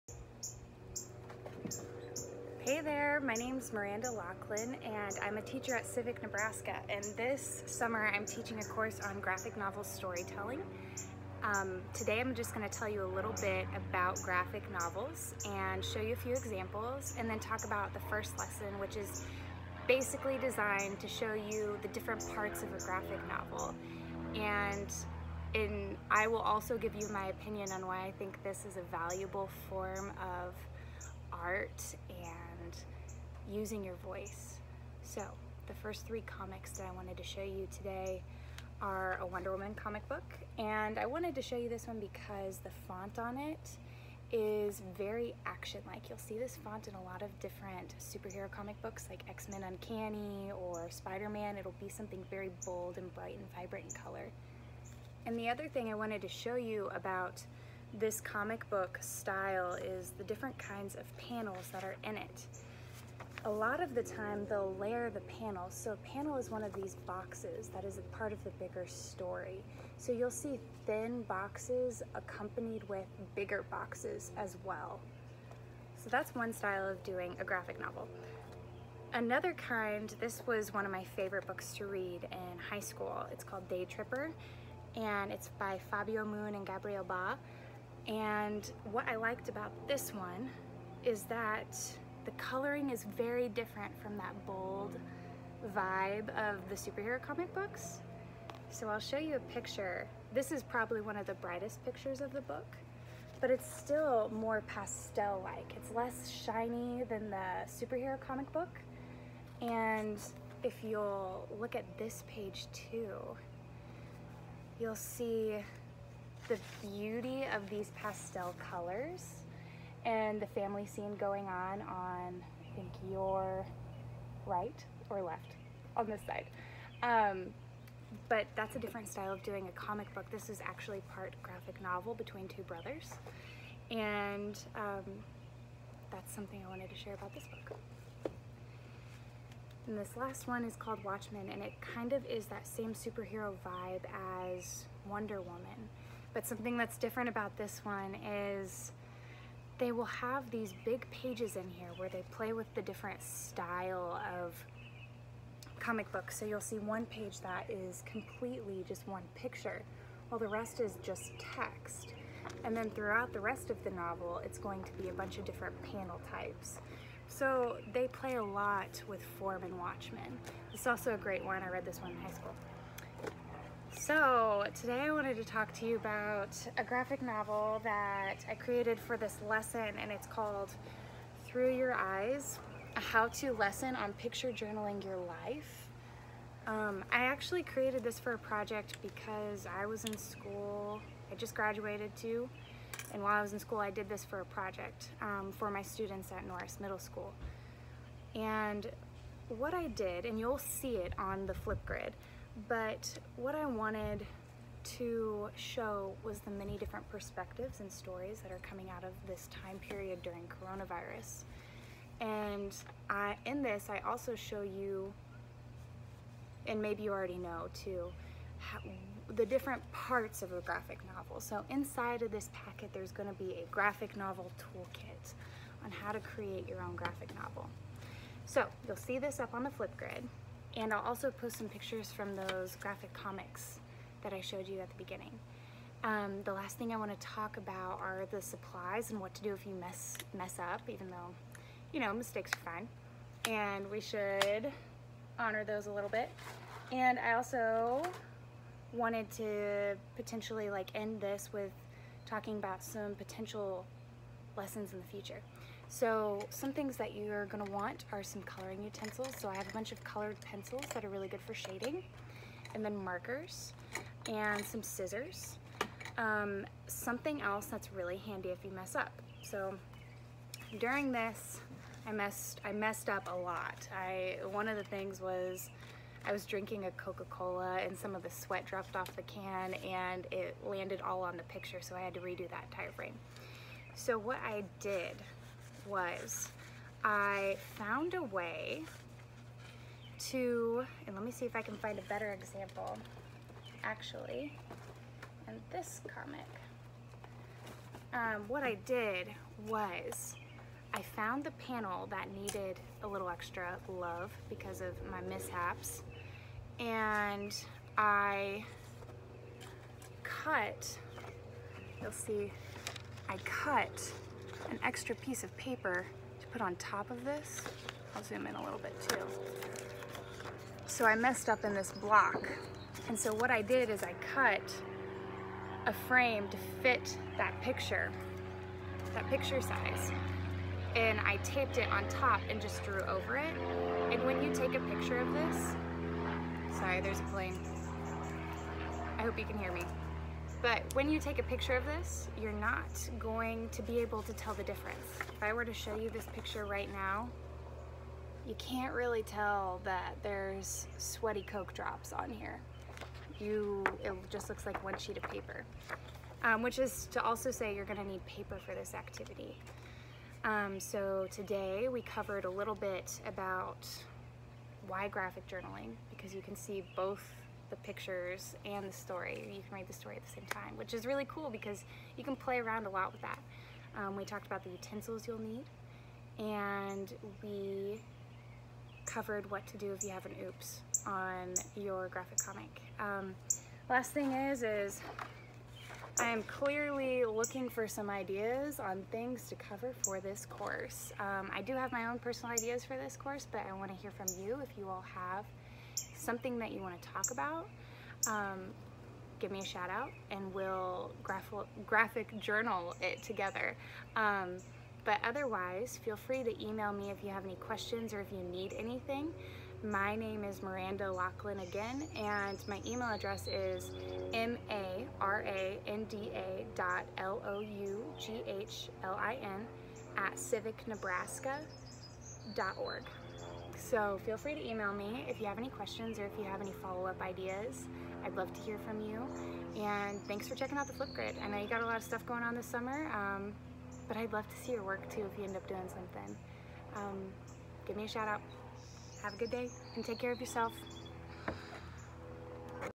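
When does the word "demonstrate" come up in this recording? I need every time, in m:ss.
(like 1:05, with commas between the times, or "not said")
not said.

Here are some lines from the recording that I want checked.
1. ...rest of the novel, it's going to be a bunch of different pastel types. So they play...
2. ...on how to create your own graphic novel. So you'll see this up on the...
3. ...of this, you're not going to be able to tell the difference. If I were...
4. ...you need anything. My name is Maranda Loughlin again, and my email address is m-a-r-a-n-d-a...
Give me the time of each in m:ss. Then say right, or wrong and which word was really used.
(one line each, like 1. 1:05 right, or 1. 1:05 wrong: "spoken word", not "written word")
1. 2:43 wrong: "panel", not "pastel"
2. 3:45 right
3. 5:41 right
4. 6:48 right.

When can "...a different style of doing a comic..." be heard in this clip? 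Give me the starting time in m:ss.
2:08.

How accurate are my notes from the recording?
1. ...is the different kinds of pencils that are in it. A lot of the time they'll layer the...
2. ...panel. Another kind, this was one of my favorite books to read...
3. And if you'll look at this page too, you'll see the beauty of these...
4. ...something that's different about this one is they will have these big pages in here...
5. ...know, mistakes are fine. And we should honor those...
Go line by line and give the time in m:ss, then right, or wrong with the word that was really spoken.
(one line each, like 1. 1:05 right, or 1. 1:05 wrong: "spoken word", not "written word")
1. 0:59 wrong: "panels", not "pencils"
2. 1:17 wrong: "novel", not "panel"
3. 1:49 right
4. 2:26 right
5. 4:01 right.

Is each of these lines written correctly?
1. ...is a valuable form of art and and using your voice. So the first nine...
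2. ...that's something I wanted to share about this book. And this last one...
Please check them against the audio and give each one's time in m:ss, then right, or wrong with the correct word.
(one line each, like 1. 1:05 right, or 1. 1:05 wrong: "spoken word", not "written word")
1. 0:28 wrong: "three", not "nine"
2. 2:16 right.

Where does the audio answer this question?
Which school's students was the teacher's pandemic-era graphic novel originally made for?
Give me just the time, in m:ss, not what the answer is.
3:16.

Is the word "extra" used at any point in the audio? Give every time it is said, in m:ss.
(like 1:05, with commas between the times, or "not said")
5:03, 5:14.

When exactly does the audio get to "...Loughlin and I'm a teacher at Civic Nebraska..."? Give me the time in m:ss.
0:04.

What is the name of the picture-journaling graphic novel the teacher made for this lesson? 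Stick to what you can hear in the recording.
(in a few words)
Through Your Eyes.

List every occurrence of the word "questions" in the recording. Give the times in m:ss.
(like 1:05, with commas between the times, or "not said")
6:47, 7:05.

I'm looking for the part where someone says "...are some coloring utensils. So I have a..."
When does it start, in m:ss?
4:18.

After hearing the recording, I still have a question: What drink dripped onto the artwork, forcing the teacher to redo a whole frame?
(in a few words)
Coca-Cola.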